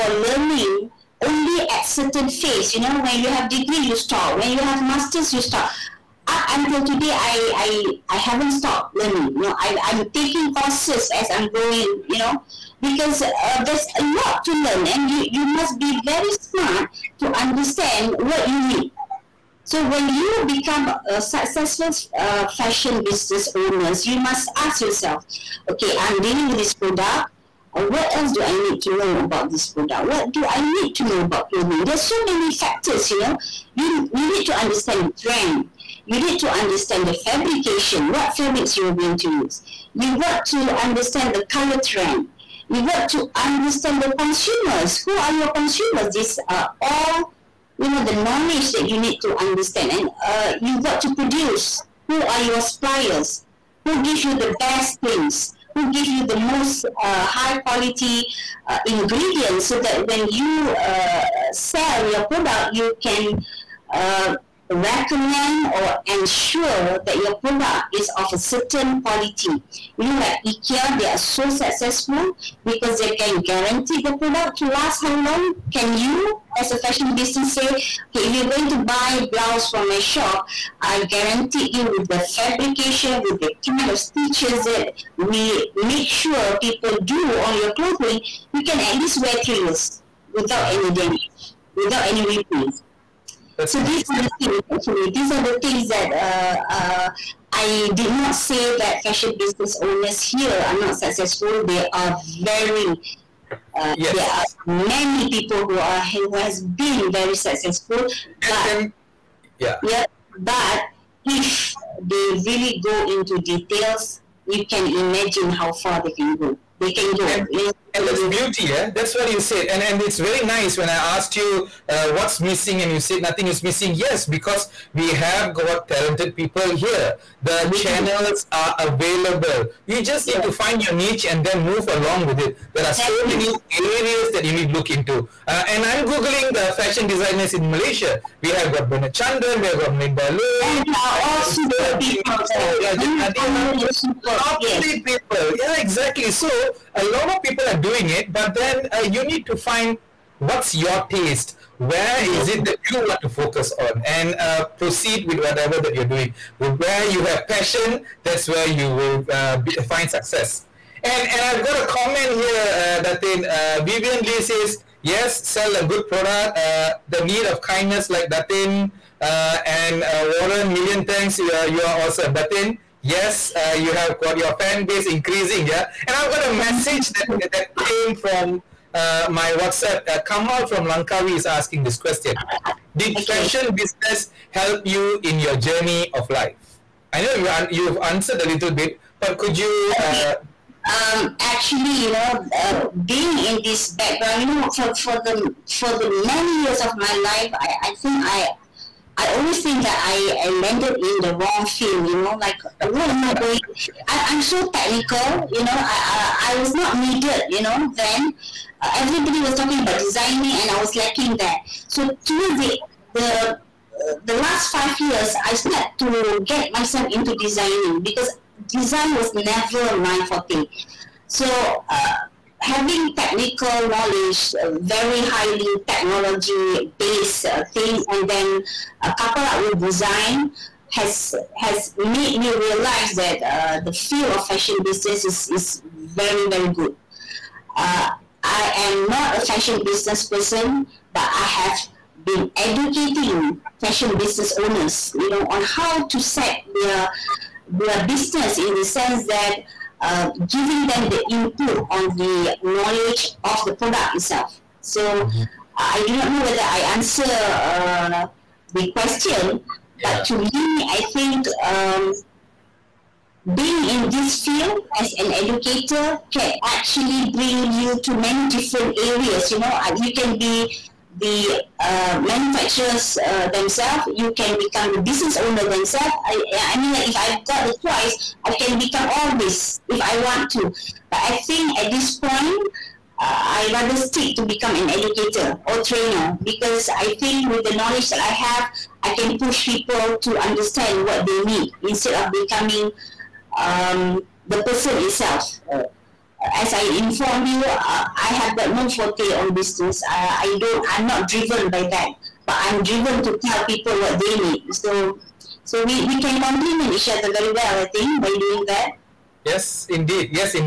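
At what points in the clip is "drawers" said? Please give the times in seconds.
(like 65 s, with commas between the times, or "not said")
not said.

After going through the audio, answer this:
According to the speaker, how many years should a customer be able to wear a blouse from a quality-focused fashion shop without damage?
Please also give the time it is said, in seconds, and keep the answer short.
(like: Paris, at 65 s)
3, at 89 s.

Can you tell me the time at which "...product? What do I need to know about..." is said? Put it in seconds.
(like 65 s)
29 s.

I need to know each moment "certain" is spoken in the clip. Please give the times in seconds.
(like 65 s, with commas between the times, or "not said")
1 s, 68 s.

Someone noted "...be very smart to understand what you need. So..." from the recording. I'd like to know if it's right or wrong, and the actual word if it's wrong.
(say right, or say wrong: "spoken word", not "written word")
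right.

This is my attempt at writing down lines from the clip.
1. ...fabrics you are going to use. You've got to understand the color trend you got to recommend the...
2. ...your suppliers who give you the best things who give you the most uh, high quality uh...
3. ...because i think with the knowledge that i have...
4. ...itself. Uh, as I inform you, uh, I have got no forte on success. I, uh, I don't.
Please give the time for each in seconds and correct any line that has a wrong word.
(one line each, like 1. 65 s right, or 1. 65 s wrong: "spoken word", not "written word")
1. 38 s wrong: "understand", not "recommend"
2. 52 s right
3. 286 s right
4. 294 s wrong: "business", not "success".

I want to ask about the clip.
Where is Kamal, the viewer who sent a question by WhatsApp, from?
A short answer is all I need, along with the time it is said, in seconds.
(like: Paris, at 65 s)
Langkawi, at 180 s.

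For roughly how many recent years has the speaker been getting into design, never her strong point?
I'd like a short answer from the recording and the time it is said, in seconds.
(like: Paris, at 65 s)
5, at 214 s.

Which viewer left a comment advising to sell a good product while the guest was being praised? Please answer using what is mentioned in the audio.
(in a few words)
Vivian Lee.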